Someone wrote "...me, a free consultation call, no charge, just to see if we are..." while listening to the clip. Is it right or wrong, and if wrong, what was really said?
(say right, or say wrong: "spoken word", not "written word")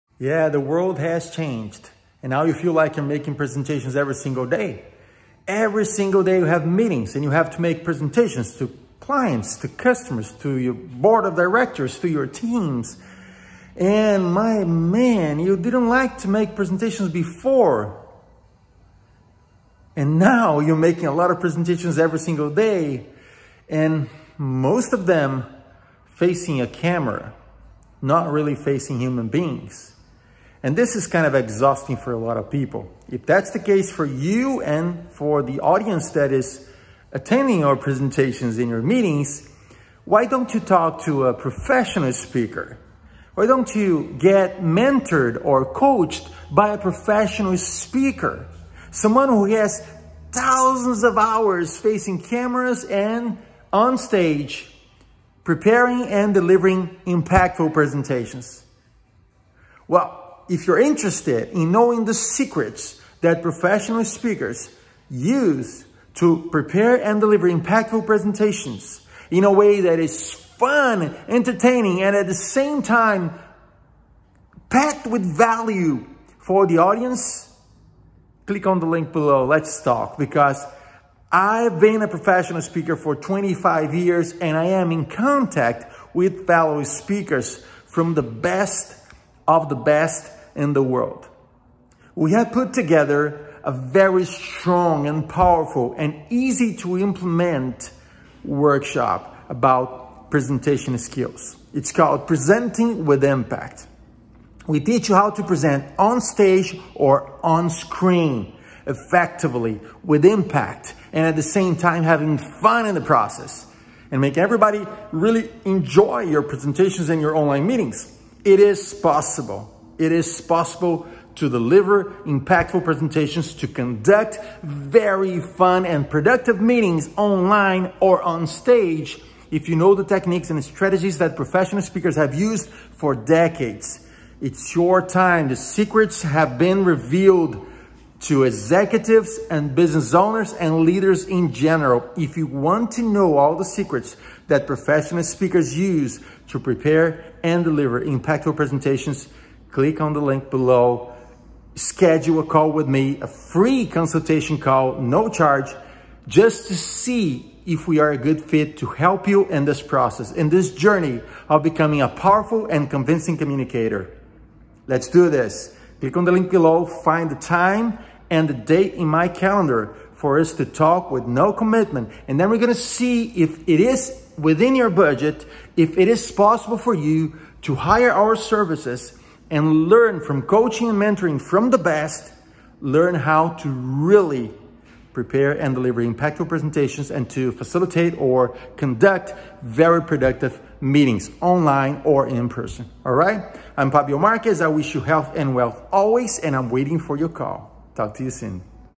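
right.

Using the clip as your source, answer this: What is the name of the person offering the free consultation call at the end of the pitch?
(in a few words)
Fabio Marques.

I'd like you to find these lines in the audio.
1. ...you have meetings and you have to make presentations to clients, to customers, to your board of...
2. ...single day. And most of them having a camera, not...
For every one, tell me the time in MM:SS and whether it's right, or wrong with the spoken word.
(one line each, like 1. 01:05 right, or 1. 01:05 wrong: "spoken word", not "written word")
1. 00:06 right
2. 00:22 wrong: "facing", not "having".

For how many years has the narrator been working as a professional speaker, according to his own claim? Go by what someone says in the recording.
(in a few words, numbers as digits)
25.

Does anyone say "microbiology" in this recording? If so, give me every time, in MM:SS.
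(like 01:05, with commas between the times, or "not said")
not said.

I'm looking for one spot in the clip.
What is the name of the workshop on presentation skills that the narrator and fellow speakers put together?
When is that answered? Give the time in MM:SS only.
01:42.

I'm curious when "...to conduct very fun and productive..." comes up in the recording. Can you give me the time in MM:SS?
02:03.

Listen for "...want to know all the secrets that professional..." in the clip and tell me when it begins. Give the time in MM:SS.
02:22.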